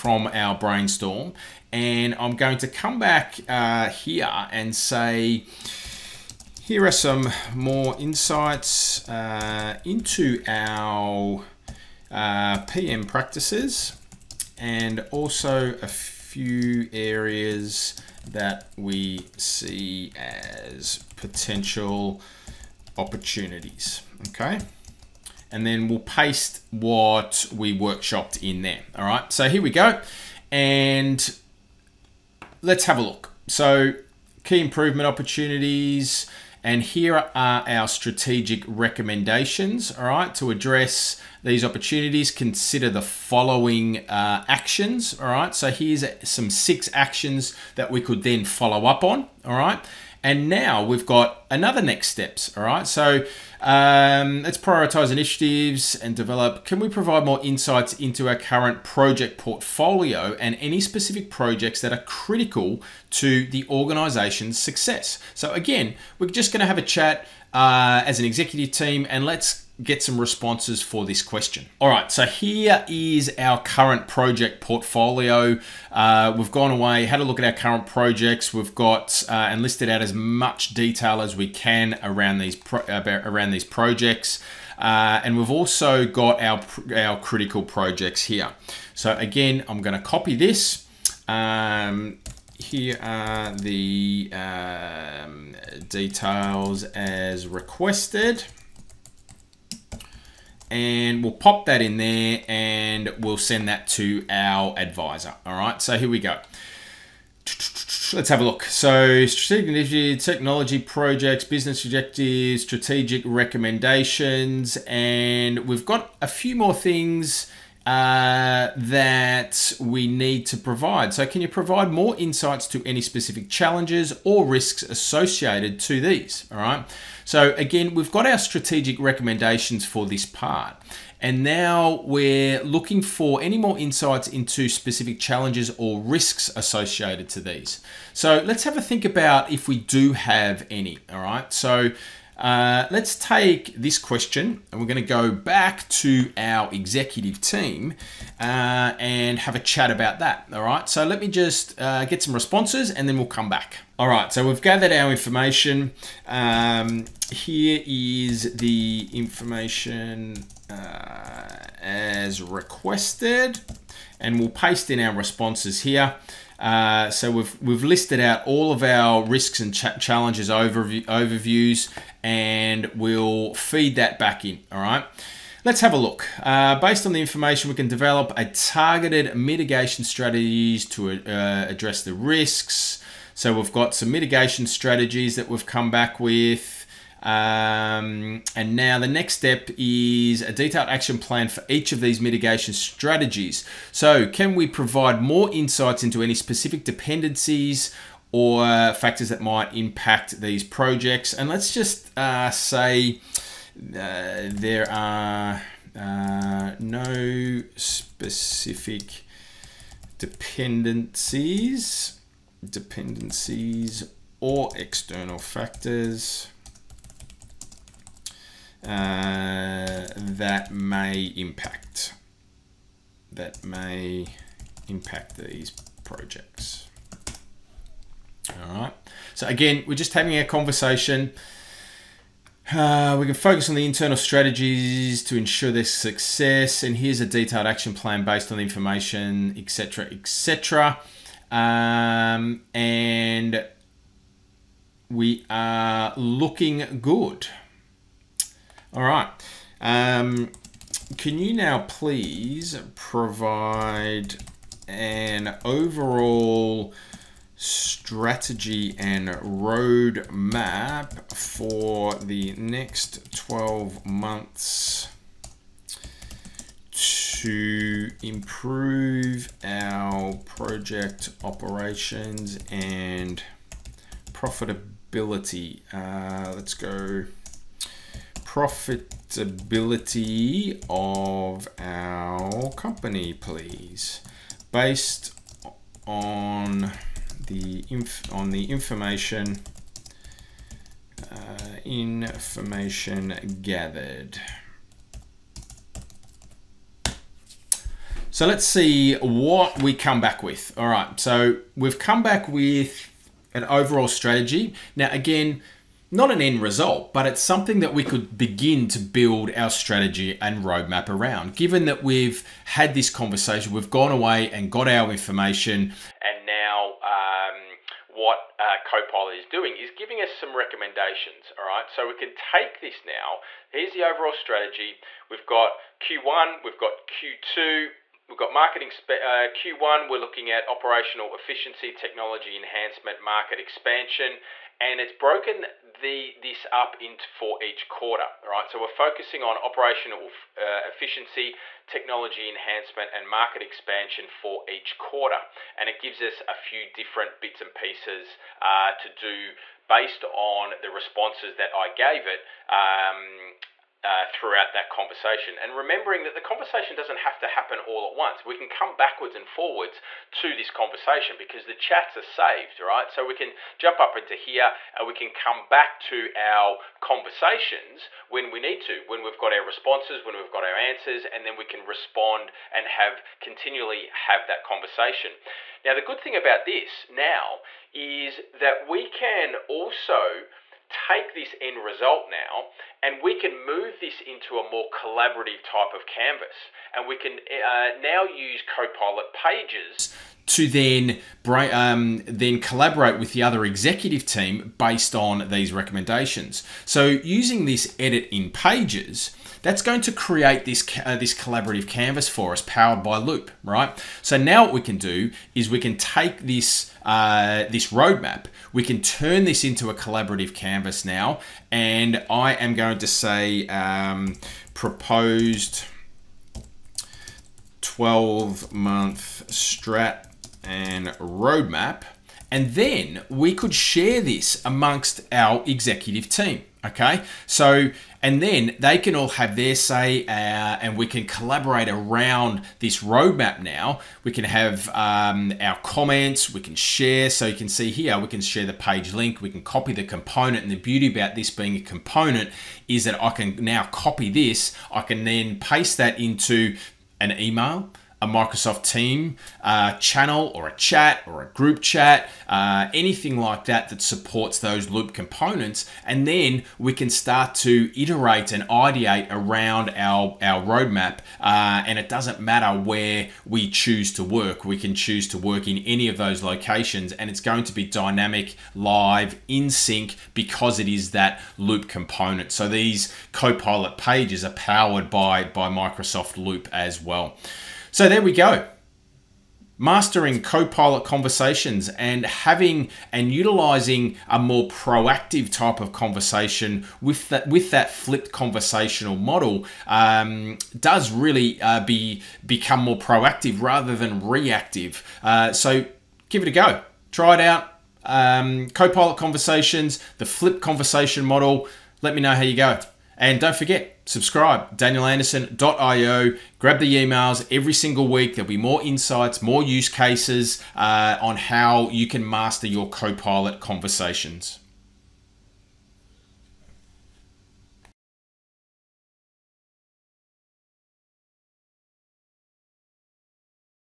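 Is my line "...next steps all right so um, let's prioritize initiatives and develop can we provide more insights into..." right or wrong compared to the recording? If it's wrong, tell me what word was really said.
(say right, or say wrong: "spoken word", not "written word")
right.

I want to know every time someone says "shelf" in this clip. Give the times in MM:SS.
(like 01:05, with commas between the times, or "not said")
not said.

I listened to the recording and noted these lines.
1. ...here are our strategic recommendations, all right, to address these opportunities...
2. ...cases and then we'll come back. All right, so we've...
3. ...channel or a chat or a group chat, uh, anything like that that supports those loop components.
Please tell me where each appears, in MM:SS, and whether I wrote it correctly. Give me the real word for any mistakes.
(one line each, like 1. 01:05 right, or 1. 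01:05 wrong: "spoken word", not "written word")
1. 00:36 right
2. 02:32 wrong: "responses", not "cases"
3. 07:29 right.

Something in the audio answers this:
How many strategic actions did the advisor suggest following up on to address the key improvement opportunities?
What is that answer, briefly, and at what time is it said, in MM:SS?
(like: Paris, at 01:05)
6, at 00:46.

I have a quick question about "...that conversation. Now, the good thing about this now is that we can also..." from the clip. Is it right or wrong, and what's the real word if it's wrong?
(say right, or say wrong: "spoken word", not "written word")
right.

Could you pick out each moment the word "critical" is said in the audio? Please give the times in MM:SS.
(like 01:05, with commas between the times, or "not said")
01:02, 01:27.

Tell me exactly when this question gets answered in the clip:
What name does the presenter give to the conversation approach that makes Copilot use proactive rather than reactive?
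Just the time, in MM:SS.
08:07.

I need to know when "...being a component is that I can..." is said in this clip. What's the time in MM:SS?
07:21.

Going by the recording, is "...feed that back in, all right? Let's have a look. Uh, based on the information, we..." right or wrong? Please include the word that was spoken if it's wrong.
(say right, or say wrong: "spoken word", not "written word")
right.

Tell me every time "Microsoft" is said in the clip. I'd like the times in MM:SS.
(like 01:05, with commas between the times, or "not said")
07:28, 07:55.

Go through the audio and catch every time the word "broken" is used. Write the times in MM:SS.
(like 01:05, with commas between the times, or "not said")
05:35.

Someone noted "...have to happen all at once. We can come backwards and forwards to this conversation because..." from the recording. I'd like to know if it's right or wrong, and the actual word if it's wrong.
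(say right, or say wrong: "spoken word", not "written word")
right.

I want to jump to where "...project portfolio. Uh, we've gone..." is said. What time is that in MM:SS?
01:14.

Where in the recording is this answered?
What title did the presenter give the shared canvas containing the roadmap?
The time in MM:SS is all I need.
06:54.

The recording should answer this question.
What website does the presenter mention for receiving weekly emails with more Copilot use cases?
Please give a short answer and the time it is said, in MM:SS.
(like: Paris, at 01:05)
danielanderson.io, at 08:24.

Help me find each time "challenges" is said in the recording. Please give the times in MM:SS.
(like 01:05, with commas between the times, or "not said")
02:03, 02:15, 02:49.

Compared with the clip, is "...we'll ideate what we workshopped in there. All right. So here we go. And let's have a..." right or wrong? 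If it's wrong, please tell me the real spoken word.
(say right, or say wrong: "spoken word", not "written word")
wrong: "paste", not "ideate".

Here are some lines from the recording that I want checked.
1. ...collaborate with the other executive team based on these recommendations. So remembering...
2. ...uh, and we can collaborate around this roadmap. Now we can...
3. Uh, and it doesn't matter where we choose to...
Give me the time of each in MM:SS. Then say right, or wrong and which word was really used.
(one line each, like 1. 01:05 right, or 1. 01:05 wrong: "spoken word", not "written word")
1. 06:32 wrong: "using", not "remembering"
2. 07:10 right
3. 07:41 right.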